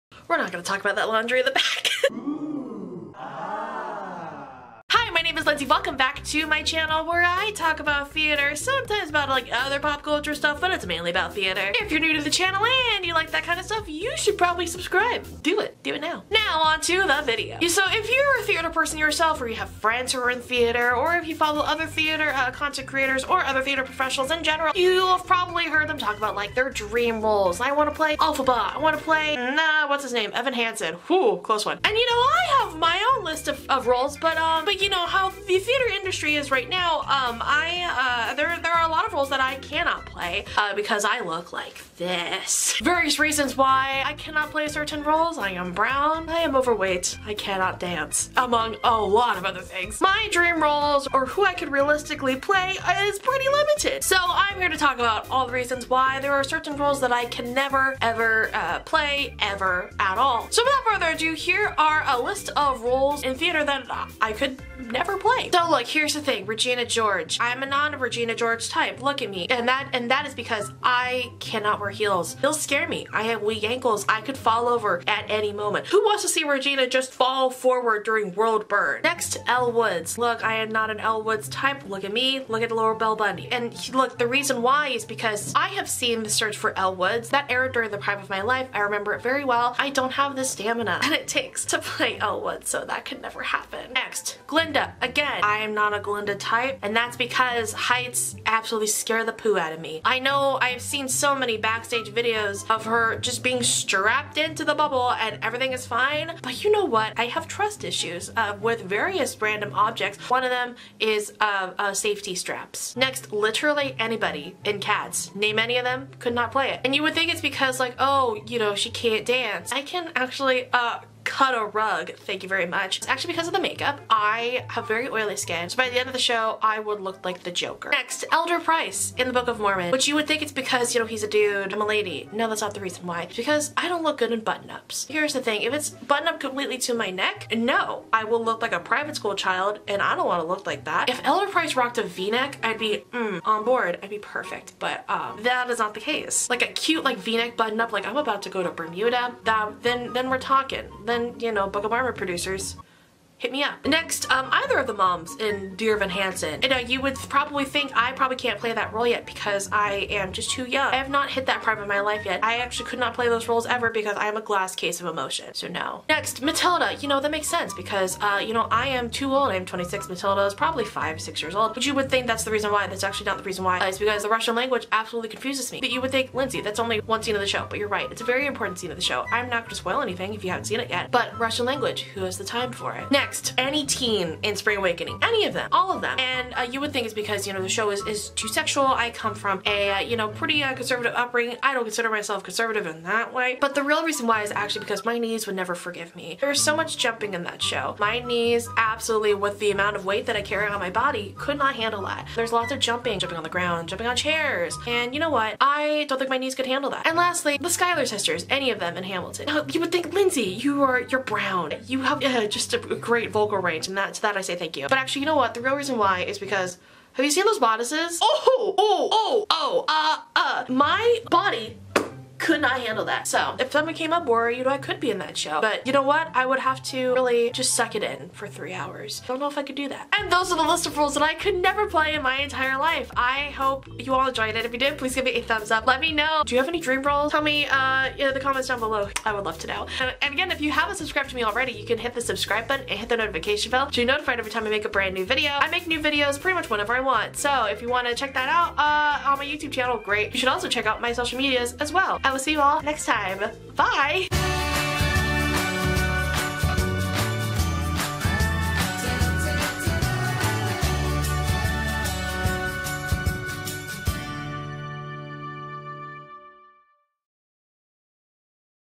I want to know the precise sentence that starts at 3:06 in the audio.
And uh, you would think it's because, you know, the show is, is too sexual.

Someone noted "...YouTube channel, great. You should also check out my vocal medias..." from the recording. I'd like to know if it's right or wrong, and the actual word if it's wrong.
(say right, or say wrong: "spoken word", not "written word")
wrong: "social", not "vocal".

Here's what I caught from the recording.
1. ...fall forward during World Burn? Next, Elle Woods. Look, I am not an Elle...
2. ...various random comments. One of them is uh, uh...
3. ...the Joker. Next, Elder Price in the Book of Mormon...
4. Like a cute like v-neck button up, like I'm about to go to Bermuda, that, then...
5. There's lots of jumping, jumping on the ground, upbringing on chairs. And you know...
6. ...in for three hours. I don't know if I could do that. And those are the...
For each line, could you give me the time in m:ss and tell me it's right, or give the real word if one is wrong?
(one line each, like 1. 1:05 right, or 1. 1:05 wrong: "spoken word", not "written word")
1. 1:17 right
2. 1:48 wrong: "objects", not "comments"
3. 2:07 right
4. 2:26 right
5. 3:22 wrong: "jumping", not "upbringing"
6. 3:48 right.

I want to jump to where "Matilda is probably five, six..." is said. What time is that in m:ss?
2:50.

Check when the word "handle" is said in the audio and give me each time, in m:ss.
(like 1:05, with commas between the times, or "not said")
3:21, 3:26, 3:42.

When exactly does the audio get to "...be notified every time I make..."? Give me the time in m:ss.
4:04.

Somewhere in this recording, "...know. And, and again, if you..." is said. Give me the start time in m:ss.
3:59.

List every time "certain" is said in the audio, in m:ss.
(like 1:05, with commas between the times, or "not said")
0:44, 0:56.